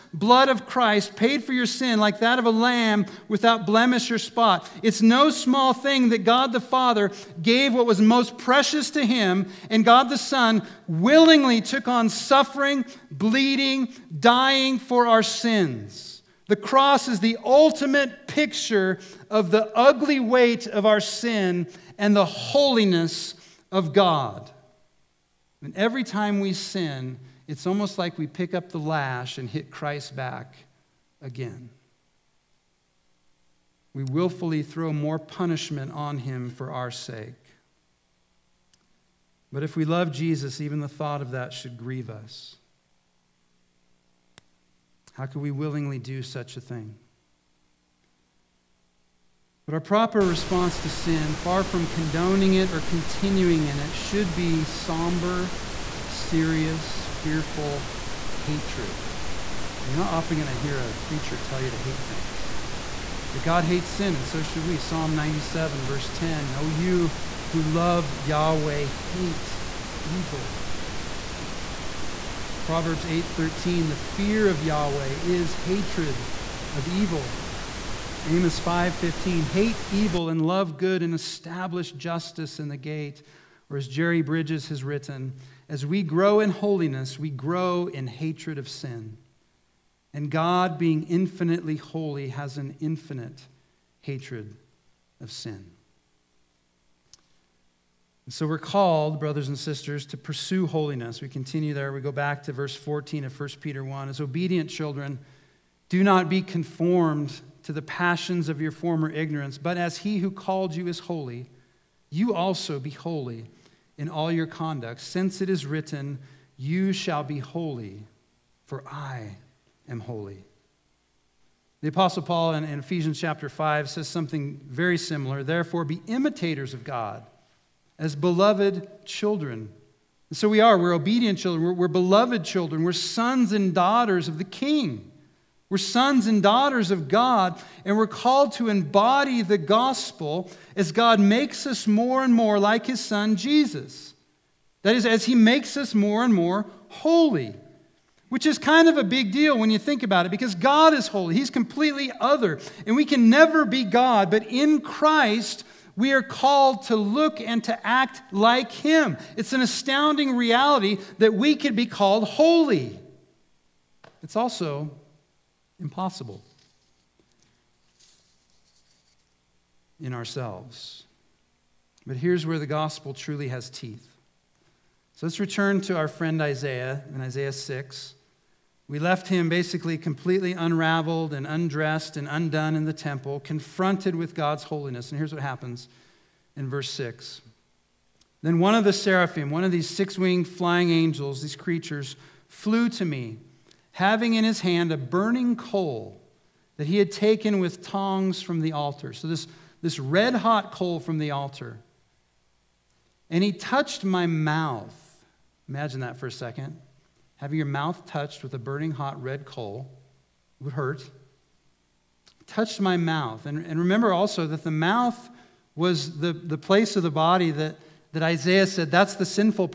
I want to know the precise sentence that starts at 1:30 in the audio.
And God, being infinitely holy, has an infinite hatred of sin.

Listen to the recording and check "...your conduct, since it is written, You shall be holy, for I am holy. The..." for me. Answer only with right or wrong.
right.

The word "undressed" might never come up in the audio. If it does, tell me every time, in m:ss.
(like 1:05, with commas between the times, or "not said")
3:01.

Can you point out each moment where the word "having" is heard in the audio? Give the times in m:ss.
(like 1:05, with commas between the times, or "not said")
3:13, 3:27.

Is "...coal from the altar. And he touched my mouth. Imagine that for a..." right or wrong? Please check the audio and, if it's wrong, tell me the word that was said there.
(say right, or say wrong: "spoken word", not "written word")
right.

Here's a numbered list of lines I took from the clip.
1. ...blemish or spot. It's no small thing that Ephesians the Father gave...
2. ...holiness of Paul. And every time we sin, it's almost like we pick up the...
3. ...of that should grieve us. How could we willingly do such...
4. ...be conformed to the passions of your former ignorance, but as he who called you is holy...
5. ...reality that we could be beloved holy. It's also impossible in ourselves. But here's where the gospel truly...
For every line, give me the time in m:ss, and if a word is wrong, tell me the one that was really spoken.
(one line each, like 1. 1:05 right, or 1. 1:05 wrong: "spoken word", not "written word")
1. 0:03 wrong: "God", not "Ephesians"
2. 0:22 wrong: "God", not "Paul"
3. 0:41 right
4. 1:46 right
5. 2:40 wrong: "called", not "beloved".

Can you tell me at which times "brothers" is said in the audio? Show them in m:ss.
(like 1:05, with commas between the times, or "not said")
1:39.